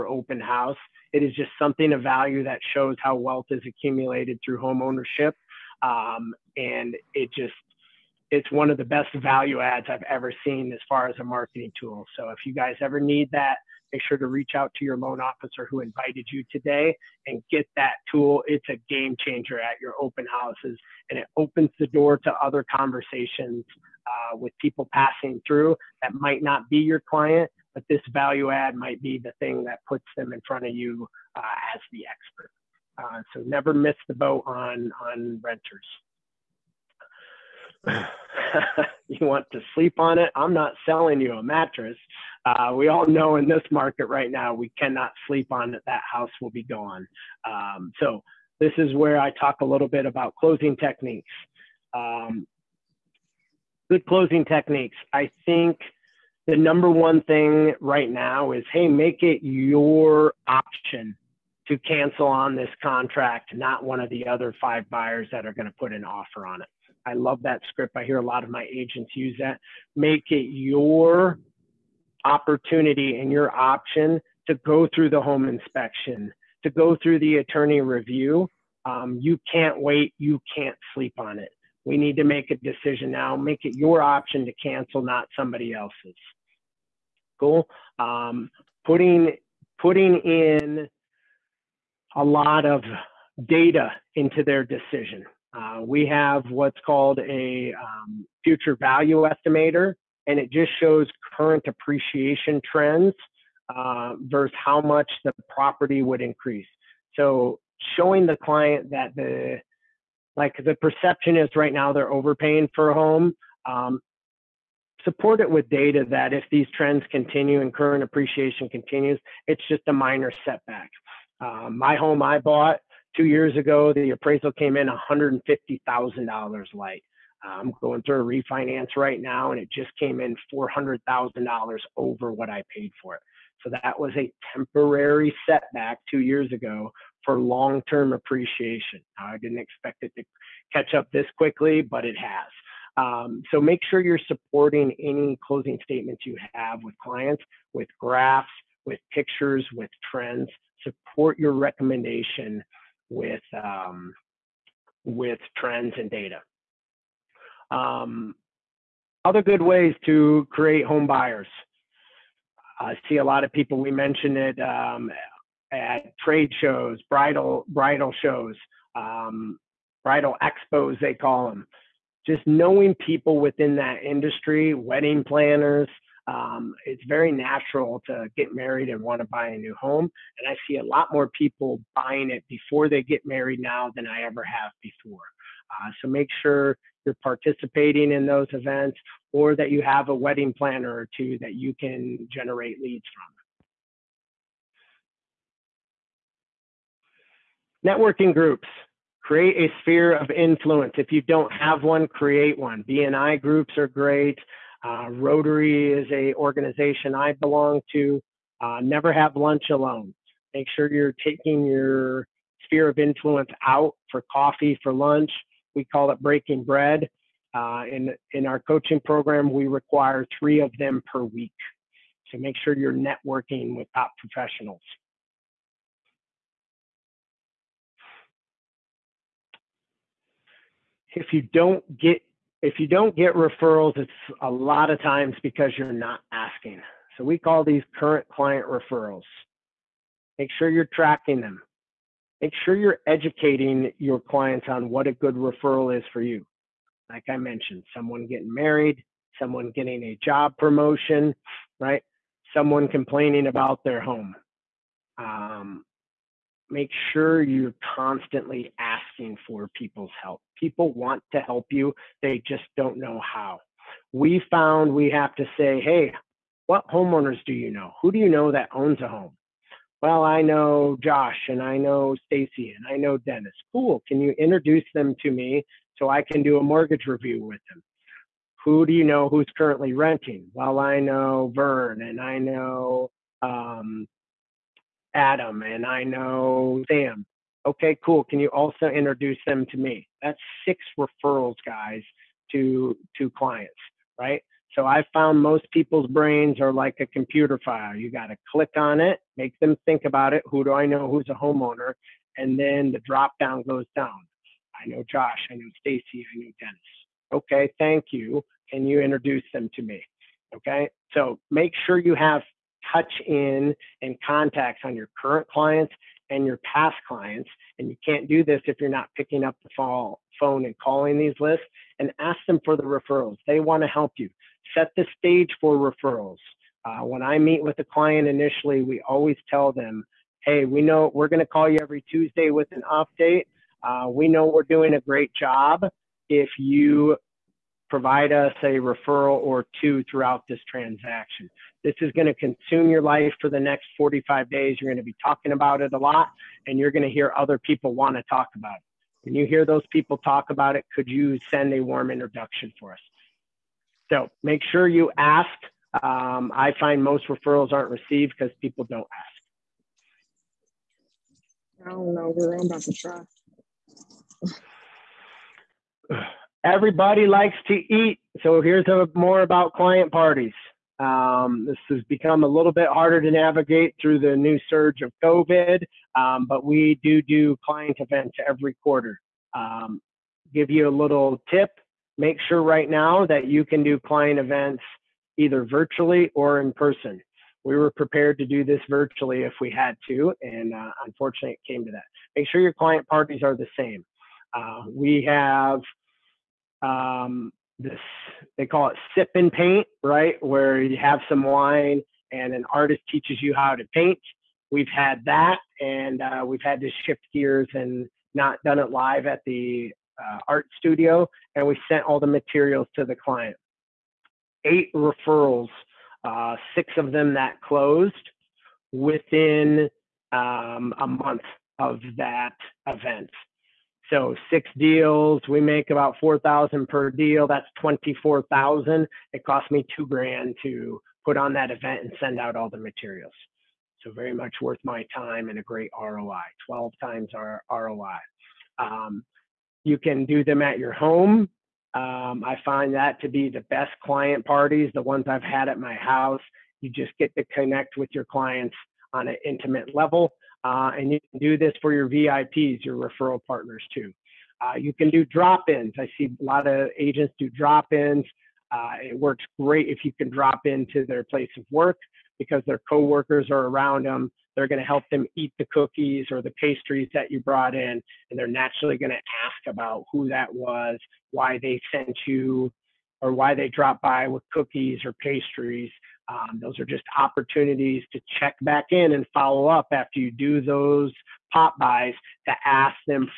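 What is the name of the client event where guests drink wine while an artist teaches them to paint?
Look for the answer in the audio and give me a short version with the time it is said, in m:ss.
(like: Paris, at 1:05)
sip and paint, at 6:39.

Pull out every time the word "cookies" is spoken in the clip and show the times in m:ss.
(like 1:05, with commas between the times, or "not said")
7:45, 7:54.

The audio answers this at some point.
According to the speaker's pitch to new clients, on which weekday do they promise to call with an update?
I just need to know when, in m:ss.
5:32.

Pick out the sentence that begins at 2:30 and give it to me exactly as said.
Support your recommendation with um, with trends and data.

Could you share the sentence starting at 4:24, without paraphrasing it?
We found we have to say, hey, what homeowners do you know?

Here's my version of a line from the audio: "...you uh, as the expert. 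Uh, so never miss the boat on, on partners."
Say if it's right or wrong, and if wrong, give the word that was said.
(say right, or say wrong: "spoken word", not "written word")
wrong: "renters", not "partners".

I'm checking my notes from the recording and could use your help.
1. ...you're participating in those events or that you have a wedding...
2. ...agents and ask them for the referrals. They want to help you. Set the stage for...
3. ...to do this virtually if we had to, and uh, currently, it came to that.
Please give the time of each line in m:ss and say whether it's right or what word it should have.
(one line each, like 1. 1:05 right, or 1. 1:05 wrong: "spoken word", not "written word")
1. 3:07 right
2. 5:21 wrong: "lists", not "agents"
3. 6:28 wrong: "unfortunately", not "currently".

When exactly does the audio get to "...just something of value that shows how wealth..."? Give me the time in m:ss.
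0:01.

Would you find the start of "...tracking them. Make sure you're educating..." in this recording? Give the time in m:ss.
4:00.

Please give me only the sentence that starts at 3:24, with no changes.
Uh, Rotary is a organization I belong to.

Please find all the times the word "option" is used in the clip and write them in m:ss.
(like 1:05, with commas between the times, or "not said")
1:00, 1:13, 1:24.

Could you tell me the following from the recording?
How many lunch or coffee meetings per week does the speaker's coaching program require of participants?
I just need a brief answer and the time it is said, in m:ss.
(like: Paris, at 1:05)
3, at 3:40.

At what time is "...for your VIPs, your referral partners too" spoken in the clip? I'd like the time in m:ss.
7:31.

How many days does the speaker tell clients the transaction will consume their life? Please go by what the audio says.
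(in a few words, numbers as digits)
45.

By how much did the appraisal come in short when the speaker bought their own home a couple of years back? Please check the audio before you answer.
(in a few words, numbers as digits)
$150,000.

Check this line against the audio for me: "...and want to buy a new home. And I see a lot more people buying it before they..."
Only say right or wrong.
right.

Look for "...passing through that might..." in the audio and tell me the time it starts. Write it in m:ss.
0:24.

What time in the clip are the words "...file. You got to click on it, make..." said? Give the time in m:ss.
4:57.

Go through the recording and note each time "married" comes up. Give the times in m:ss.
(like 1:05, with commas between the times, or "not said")
2:58, 3:03, 4:08.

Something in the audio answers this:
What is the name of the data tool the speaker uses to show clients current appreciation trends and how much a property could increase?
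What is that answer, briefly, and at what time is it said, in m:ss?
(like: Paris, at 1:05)
future value estimator, at 1:38.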